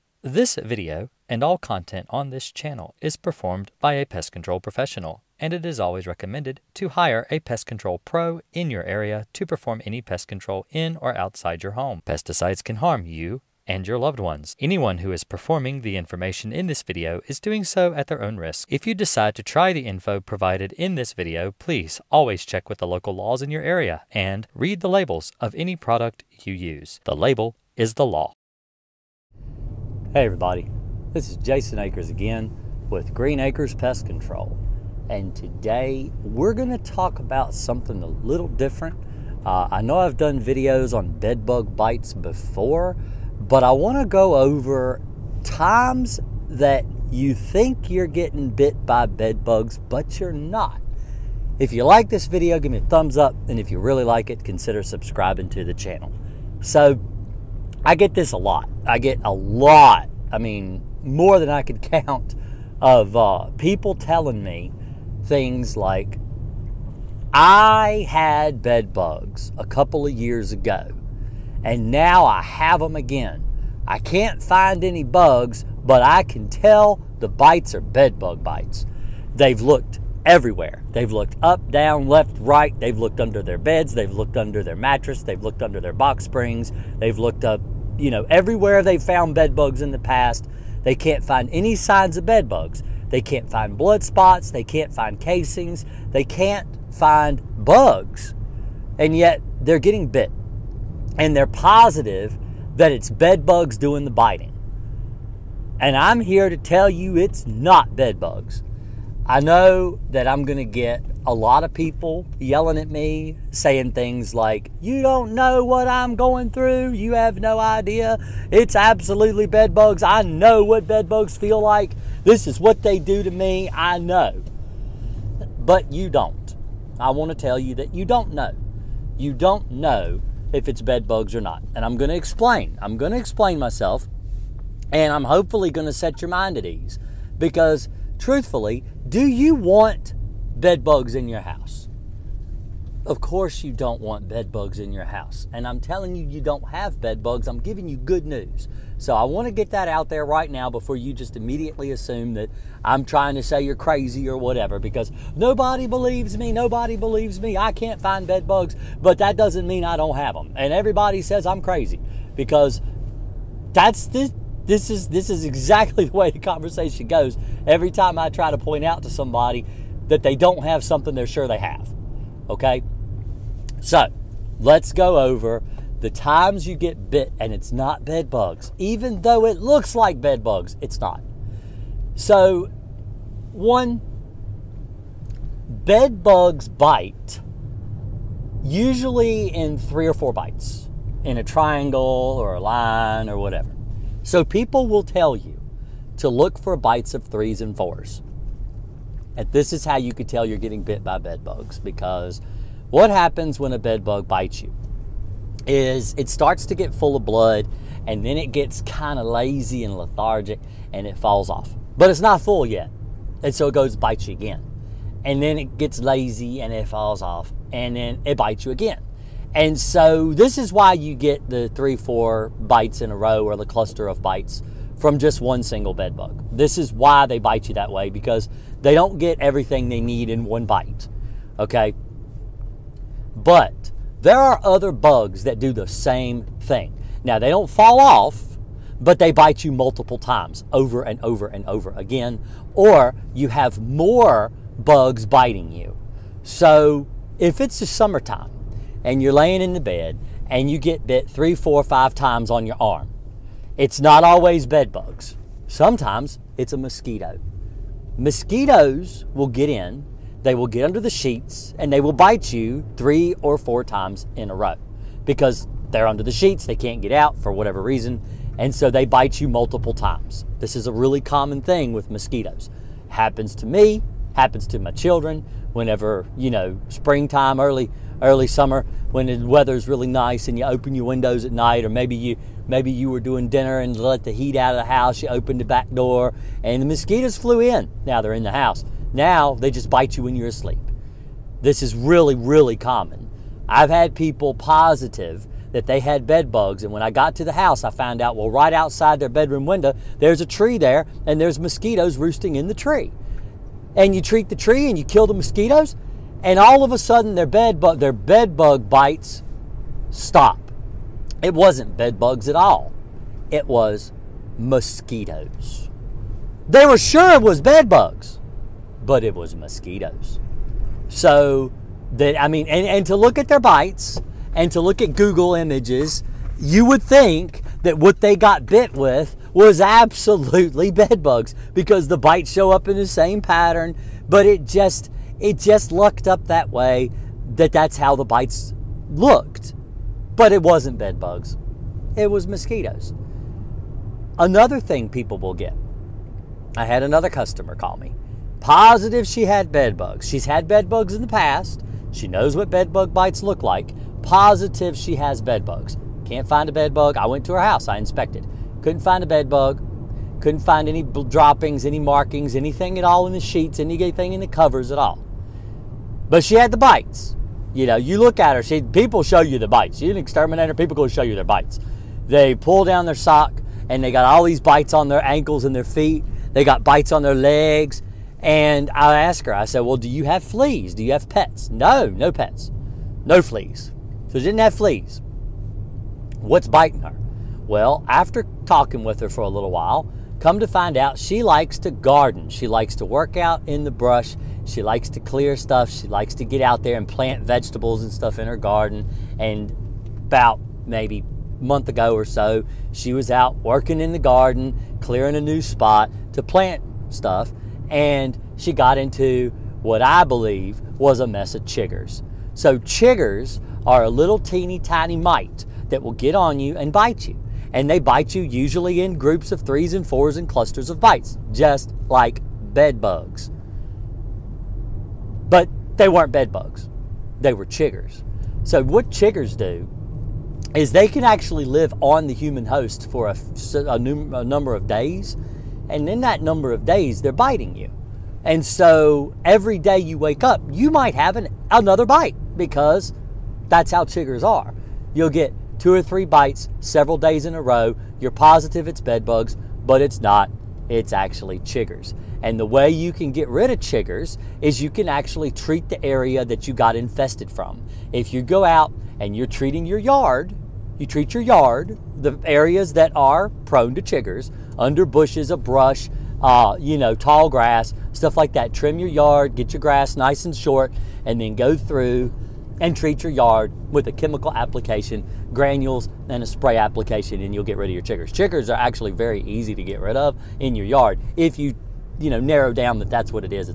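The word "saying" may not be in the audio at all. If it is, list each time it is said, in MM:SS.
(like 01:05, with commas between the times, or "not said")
01:53.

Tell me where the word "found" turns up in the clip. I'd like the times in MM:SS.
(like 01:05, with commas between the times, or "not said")
01:29, 04:57.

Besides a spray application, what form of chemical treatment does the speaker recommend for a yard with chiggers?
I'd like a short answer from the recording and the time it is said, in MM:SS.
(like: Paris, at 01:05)
granules, at 07:55.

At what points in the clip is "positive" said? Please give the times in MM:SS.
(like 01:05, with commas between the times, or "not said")
01:41, 04:54, 05:48, 05:54, 07:28.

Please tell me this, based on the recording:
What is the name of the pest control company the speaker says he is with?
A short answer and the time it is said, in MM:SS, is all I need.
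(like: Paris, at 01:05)
Green Akers Pest Control, at 00:33.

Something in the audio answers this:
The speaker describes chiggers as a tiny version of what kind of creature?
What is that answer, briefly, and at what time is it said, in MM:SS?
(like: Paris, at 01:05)
mite, at 06:55.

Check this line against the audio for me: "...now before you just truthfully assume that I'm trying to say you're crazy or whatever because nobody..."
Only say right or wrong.
wrong.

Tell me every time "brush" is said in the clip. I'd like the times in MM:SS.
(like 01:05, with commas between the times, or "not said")
06:33, 07:45.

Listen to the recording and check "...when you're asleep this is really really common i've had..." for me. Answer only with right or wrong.
right.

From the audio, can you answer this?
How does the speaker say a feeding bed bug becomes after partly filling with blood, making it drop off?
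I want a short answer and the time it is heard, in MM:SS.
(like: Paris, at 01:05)
lazy and lethargic, at 03:29.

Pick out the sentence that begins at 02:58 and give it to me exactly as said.
Even though it looks like bed bugs, it's not.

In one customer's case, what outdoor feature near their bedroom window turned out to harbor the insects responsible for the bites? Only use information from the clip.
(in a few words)
a tree.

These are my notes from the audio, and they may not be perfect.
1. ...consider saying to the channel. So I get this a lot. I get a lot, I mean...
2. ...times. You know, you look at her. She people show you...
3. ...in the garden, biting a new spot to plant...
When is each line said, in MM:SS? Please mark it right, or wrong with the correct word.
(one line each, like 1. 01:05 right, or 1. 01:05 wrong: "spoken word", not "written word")
1. 00:54 wrong: "subscribing", not "saying"
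2. 06:06 wrong: "bites", not "times"
3. 06:43 wrong: "clearing", not "biting".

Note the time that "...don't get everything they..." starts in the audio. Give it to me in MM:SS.
03:48.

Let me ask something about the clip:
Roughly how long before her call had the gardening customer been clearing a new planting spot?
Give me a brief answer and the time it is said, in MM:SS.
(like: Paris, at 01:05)
a month, at 06:39.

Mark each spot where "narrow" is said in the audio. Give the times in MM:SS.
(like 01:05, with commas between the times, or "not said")
08:02.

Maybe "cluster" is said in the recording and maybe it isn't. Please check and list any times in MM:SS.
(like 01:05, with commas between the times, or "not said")
03:43, 07:00.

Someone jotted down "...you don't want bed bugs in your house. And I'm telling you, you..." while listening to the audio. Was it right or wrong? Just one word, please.
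right.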